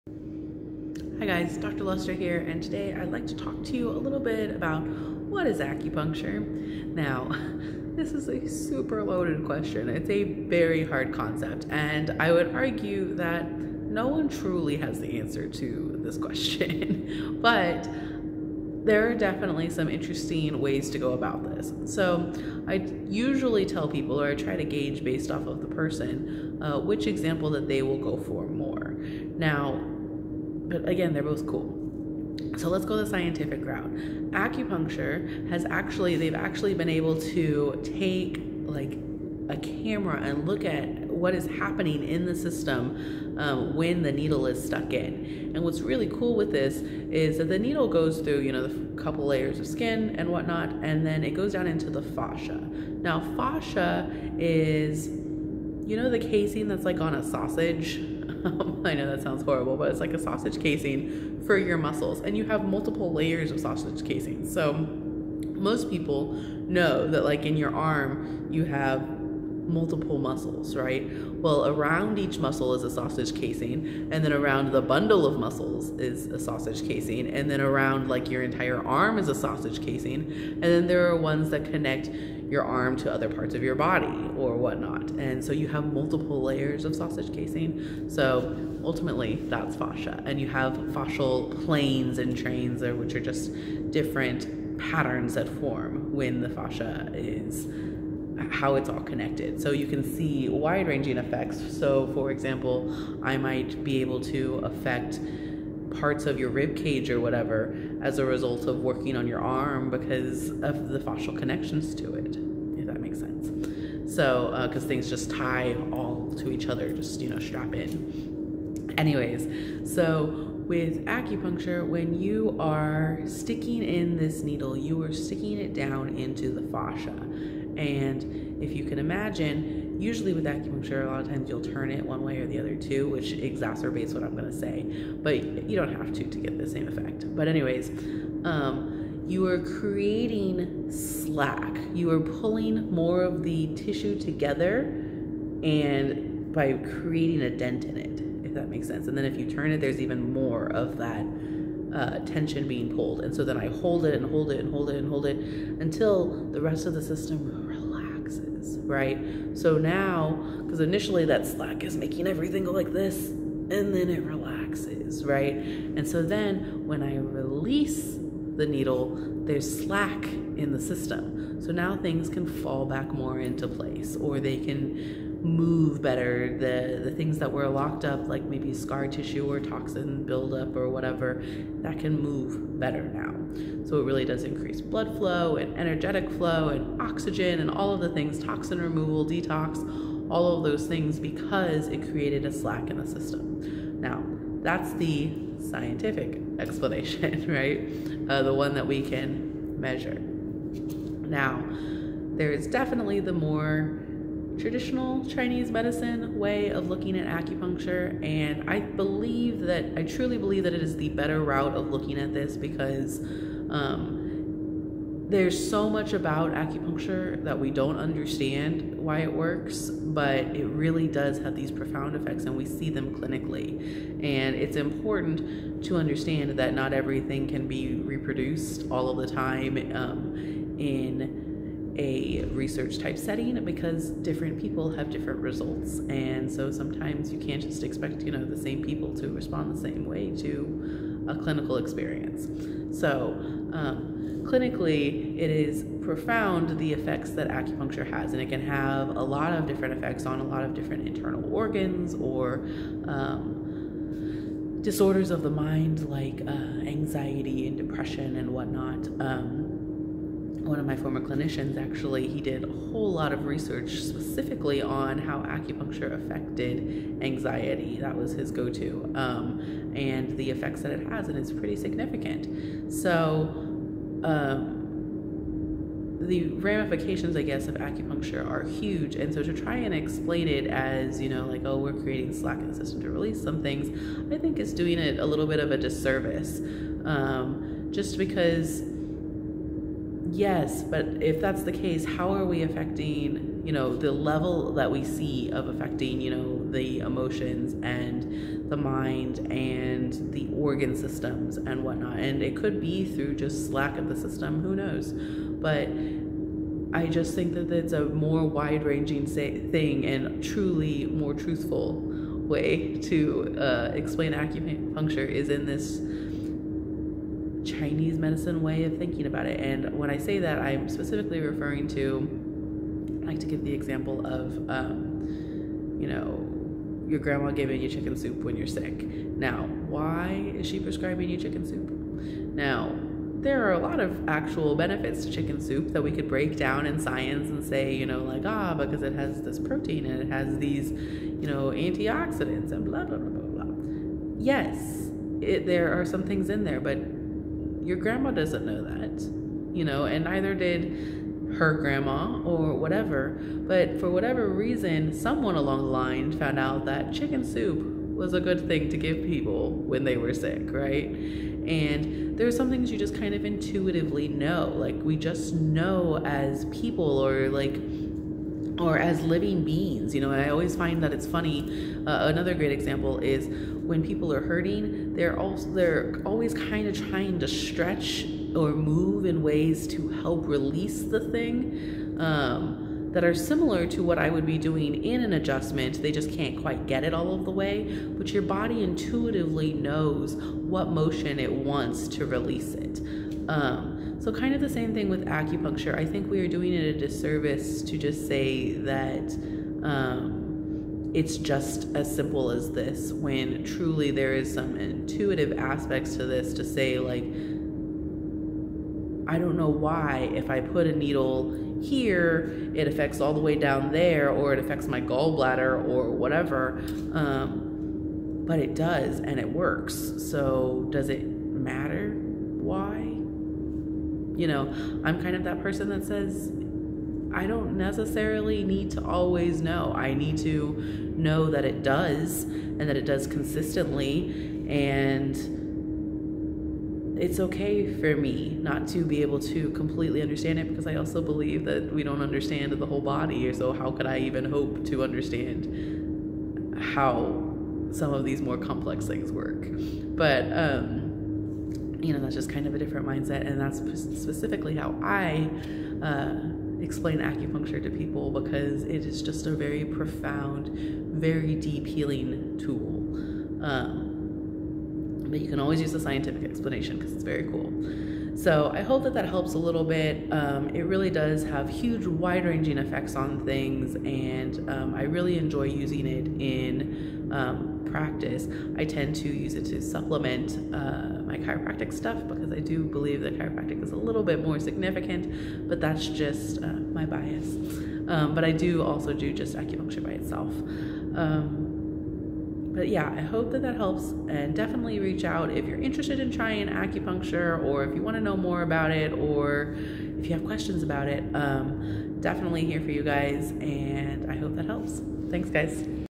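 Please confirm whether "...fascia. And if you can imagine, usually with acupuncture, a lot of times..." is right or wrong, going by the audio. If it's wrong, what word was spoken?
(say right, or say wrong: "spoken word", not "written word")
right.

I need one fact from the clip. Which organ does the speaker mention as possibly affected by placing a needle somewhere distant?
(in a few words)
gallbladder.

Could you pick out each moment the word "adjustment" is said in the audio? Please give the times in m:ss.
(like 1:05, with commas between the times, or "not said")
6:25.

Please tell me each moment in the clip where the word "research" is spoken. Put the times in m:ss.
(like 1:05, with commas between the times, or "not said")
3:52, 4:23.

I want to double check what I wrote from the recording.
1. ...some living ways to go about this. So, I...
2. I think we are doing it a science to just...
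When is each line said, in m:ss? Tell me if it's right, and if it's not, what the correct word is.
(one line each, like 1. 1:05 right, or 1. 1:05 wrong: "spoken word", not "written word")
1. 0:19 wrong: "interesting", not "living"
2. 6:35 wrong: "disservice", not "science".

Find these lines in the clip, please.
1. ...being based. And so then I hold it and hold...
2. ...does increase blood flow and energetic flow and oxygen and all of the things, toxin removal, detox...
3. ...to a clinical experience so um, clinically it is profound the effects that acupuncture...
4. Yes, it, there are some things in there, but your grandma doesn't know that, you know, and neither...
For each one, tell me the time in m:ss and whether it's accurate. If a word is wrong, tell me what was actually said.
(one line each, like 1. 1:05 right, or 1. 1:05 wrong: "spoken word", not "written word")
1. 2:32 wrong: "pulled", not "based"
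2. 3:04 right
3. 4:00 right
4. 5:44 right.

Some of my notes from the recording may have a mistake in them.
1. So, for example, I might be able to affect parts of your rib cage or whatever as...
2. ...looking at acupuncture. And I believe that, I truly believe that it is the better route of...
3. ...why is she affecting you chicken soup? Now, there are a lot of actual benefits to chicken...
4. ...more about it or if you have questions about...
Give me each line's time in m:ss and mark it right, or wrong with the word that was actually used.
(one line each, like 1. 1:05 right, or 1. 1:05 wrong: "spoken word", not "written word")
1. 1:41 right
2. 3:26 right
3. 5:29 wrong: "prescribing", not "affecting"
4. 8:18 right.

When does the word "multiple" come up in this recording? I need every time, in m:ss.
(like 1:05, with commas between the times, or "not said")
1:02, 1:09, 1:25.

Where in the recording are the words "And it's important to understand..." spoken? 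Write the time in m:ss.
3:44.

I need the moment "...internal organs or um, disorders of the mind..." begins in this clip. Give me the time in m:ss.
4:11.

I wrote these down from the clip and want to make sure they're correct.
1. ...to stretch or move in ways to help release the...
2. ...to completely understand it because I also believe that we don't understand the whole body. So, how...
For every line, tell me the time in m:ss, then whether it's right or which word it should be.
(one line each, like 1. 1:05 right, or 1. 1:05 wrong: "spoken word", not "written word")
1. 6:17 right
2. 7:19 right.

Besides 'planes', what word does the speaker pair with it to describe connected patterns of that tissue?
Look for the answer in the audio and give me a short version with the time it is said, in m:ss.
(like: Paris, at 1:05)
trains, at 1:32.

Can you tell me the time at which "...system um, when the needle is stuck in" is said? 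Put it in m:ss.
0:42.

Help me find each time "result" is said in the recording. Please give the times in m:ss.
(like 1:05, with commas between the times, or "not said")
1:48, 3:55.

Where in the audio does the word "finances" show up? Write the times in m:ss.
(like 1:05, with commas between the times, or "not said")
not said.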